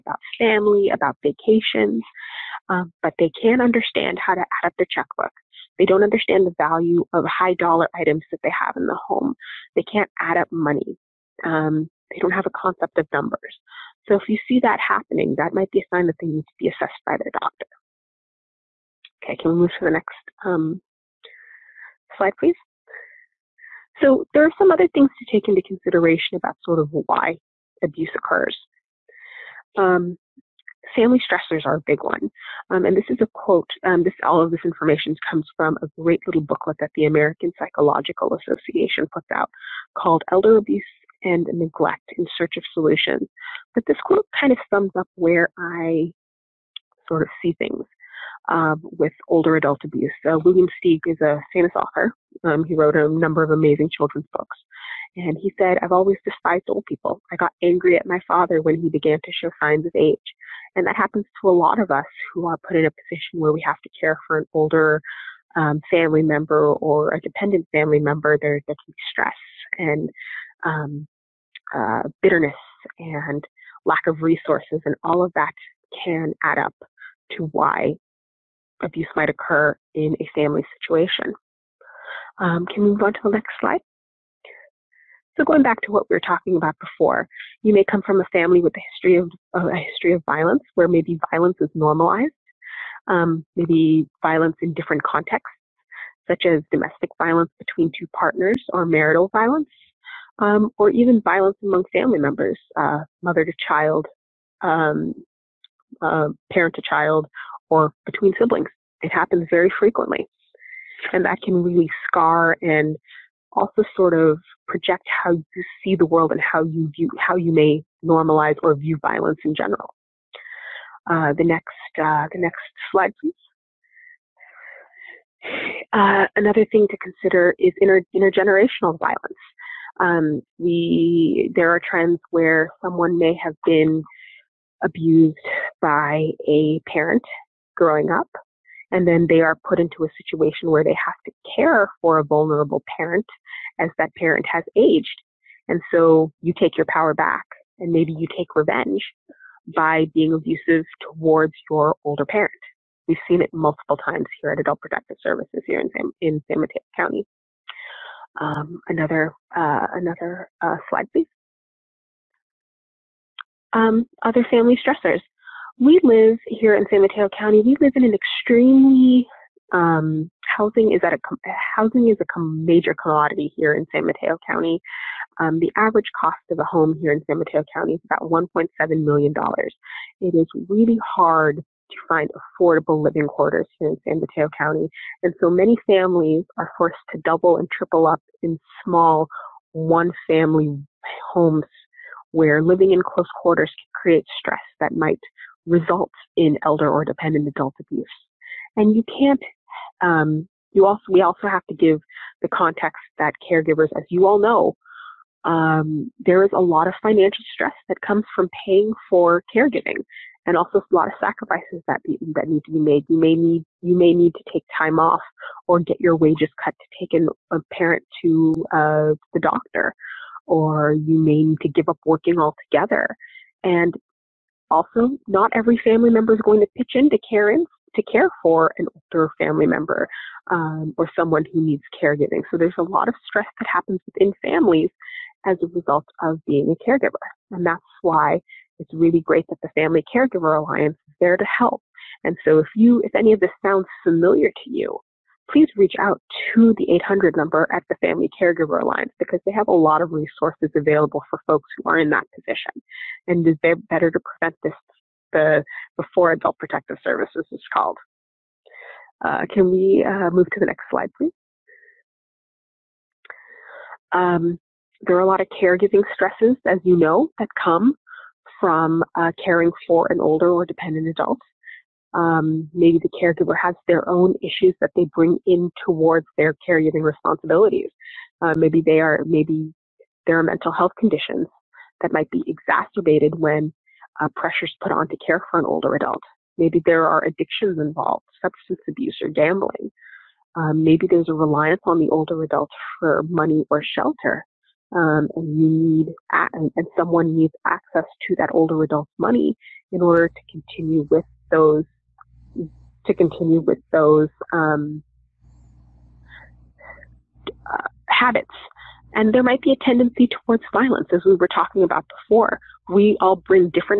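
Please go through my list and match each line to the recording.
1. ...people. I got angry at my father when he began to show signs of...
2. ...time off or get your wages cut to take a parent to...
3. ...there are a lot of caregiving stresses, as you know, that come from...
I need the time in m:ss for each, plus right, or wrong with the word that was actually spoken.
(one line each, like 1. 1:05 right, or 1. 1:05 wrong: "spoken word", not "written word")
1. 0:56 right
2. 3:34 right
3. 4:25 right.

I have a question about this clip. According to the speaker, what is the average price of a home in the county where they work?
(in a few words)
$1.7 million.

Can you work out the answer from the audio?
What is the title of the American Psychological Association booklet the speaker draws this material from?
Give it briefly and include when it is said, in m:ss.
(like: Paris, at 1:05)
Elder Abuse and Neglect in Search of Solutions, at 0:40.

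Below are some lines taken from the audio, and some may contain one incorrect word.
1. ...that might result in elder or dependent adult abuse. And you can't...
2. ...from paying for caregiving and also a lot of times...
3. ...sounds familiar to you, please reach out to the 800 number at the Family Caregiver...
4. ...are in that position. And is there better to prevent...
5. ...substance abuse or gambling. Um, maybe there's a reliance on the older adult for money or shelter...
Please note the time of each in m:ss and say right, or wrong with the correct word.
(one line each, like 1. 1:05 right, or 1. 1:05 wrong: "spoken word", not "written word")
1. 3:14 right
2. 3:28 wrong: "sacrifices", not "times"
3. 4:03 right
4. 4:11 right
5. 4:48 right.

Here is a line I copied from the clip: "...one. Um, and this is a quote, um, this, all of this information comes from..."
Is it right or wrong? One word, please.
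right.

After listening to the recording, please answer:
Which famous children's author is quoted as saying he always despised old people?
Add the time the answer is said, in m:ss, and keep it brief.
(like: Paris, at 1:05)
William Steig, at 0:50.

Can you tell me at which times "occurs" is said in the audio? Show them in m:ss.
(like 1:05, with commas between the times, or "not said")
0:28, 1:19.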